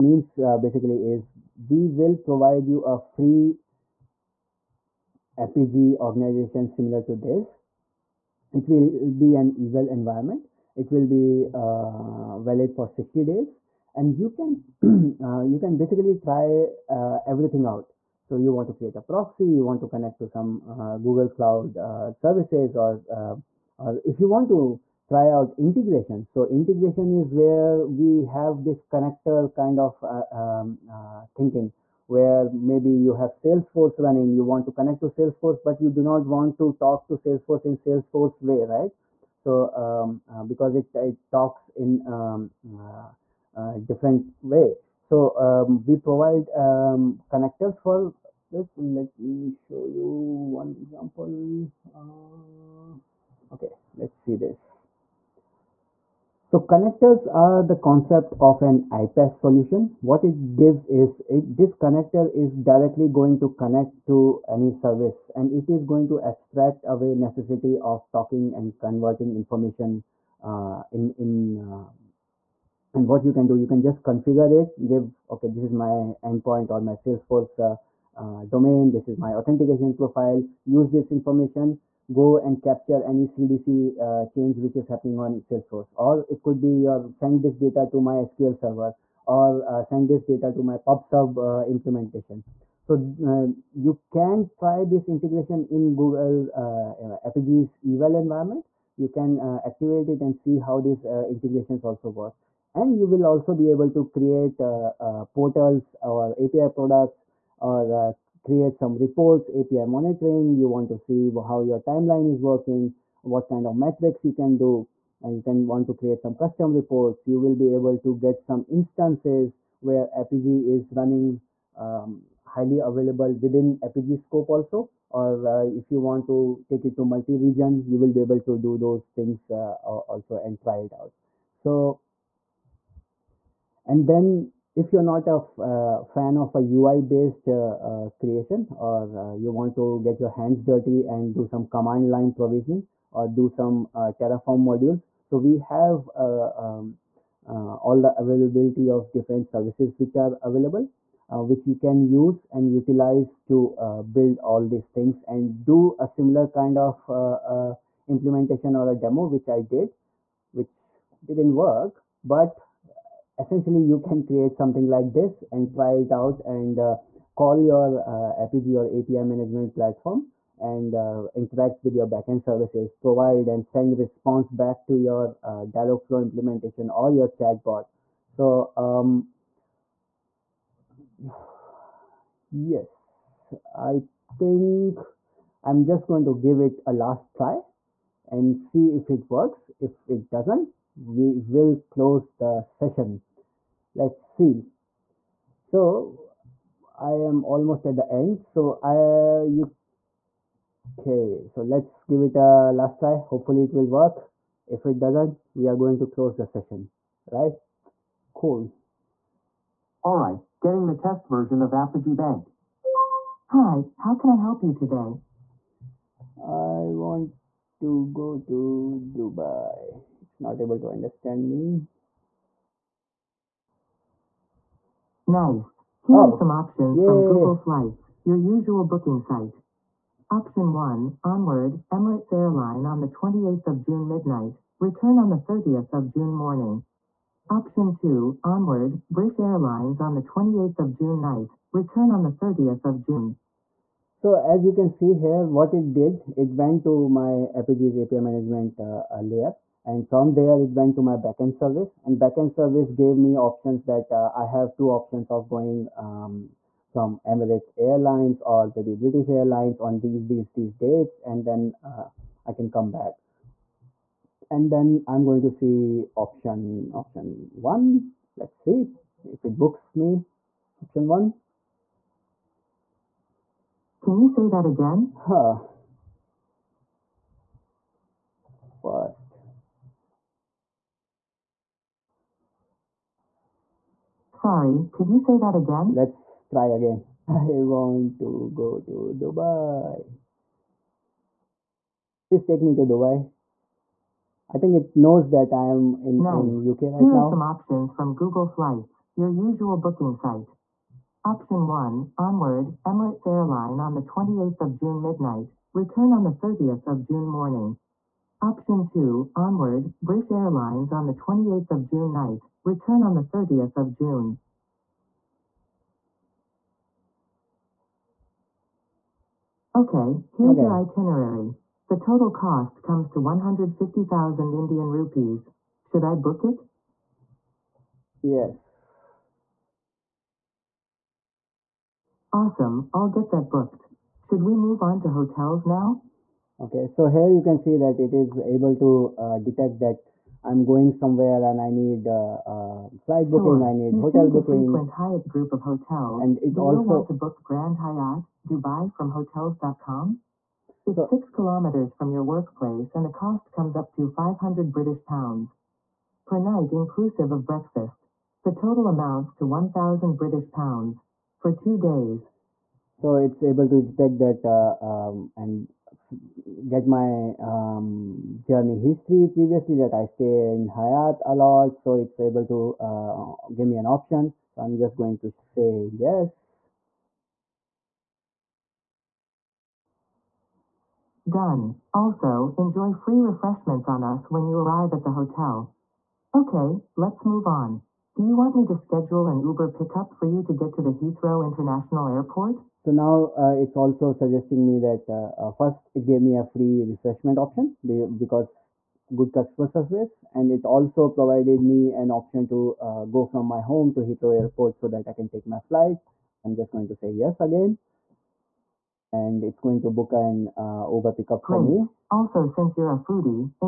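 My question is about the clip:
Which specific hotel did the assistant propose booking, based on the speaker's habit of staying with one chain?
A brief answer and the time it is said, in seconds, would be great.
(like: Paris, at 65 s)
Grand Hyatt, Dubai, at 347 s.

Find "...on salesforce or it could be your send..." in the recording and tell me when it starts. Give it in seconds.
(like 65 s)
85 s.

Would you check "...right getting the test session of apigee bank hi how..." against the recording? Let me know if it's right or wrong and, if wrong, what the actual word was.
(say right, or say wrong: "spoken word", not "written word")
wrong: "version", not "session".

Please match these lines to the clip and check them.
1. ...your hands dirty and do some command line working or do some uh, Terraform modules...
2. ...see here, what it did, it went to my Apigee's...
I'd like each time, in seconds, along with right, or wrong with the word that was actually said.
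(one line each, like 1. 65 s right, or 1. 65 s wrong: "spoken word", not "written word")
1. 140 s wrong: "provisioning", not "working"
2. 244 s right.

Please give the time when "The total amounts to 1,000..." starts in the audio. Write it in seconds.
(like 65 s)
358 s.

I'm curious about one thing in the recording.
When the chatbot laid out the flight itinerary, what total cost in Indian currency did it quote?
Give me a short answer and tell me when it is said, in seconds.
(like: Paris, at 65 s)
150,000 Indian rupees, at 323 s.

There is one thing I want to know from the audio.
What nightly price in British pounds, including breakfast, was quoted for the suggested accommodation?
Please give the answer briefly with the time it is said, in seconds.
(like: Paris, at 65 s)
500 British pounds, at 354 s.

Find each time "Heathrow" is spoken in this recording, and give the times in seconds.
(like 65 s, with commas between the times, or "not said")
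390 s, 403 s.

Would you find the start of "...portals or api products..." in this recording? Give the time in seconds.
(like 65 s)
105 s.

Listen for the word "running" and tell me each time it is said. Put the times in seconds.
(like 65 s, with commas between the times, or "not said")
34 s, 120 s.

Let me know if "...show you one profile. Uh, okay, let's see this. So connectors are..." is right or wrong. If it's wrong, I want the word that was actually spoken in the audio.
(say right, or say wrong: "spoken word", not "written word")
wrong: "example", not "profile".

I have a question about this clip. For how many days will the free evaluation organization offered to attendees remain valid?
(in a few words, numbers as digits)
60.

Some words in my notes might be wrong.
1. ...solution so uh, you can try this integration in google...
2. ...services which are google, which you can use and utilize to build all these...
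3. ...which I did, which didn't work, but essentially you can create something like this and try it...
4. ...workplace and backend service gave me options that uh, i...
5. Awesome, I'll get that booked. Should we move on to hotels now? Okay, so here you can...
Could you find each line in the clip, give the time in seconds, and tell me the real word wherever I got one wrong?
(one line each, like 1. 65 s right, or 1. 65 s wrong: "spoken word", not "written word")
1. 91 s wrong: "implementation", not "solution"
2. 149 s wrong: "available", not "google"
3. 159 s right
4. 251 s wrong: "service", not "workplace"
5. 332 s right.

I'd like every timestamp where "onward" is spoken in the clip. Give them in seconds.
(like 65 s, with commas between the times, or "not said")
231 s, 238 s, 302 s, 309 s.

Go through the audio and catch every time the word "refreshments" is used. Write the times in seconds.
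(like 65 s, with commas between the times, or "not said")
383 s, 396 s.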